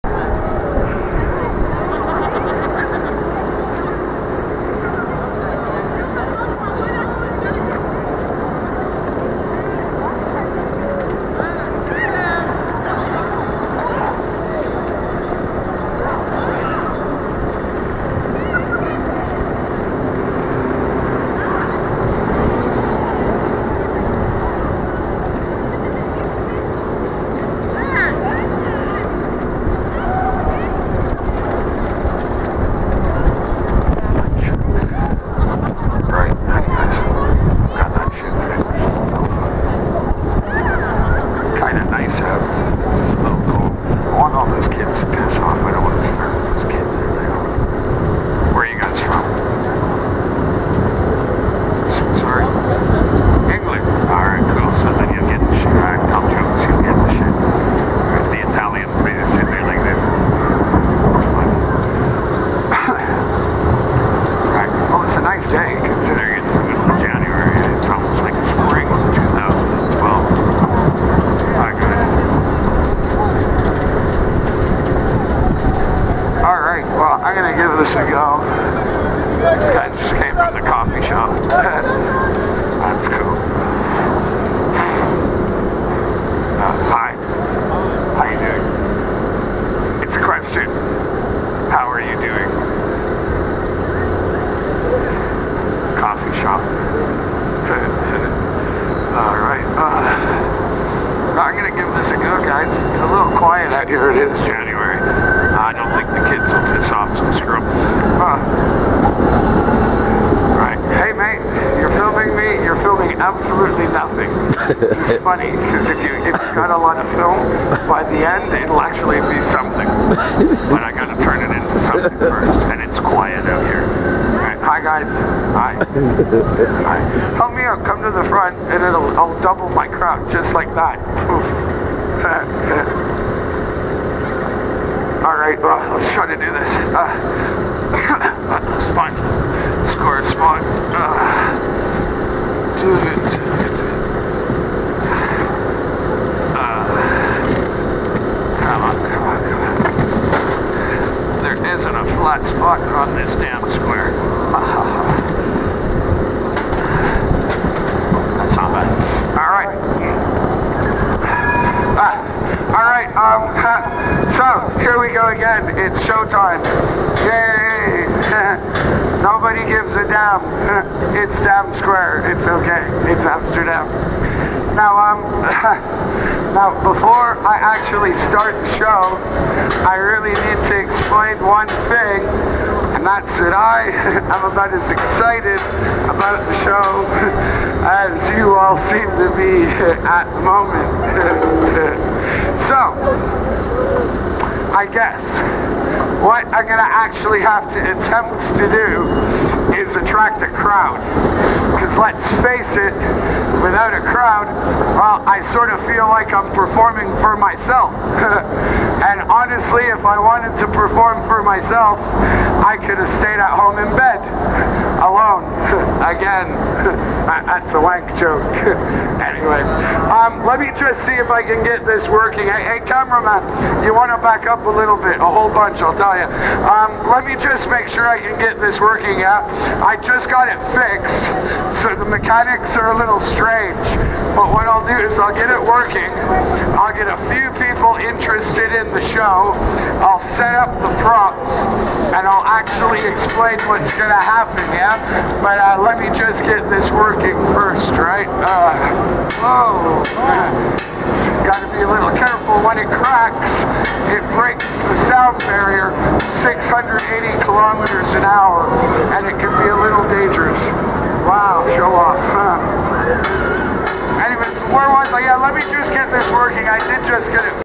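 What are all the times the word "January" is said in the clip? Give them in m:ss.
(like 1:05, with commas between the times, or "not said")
1:44.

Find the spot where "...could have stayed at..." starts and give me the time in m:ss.
3:32.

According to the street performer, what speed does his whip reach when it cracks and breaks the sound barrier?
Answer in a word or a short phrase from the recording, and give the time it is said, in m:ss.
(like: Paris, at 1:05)
680 kilometers an hour, at 4:16.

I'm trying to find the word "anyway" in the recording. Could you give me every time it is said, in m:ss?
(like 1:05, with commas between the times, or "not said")
3:39, 4:24.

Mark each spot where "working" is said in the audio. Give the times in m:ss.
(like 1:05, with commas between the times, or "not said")
3:42, 3:48, 3:55, 4:06, 4:26.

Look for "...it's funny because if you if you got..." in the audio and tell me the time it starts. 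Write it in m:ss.
1:55.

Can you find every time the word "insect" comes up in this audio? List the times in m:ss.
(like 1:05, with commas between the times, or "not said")
not said.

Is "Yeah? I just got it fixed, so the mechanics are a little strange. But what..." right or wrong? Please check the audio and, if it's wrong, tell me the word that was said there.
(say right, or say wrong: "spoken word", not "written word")
right.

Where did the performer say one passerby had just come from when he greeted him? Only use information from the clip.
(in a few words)
the coffee shop.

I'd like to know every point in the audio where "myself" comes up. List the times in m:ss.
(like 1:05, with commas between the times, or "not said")
3:27, 3:31.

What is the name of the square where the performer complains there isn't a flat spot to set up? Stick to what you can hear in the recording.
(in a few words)
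Dam Square.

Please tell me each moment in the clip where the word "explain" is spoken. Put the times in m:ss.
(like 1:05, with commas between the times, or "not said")
3:00, 4:03.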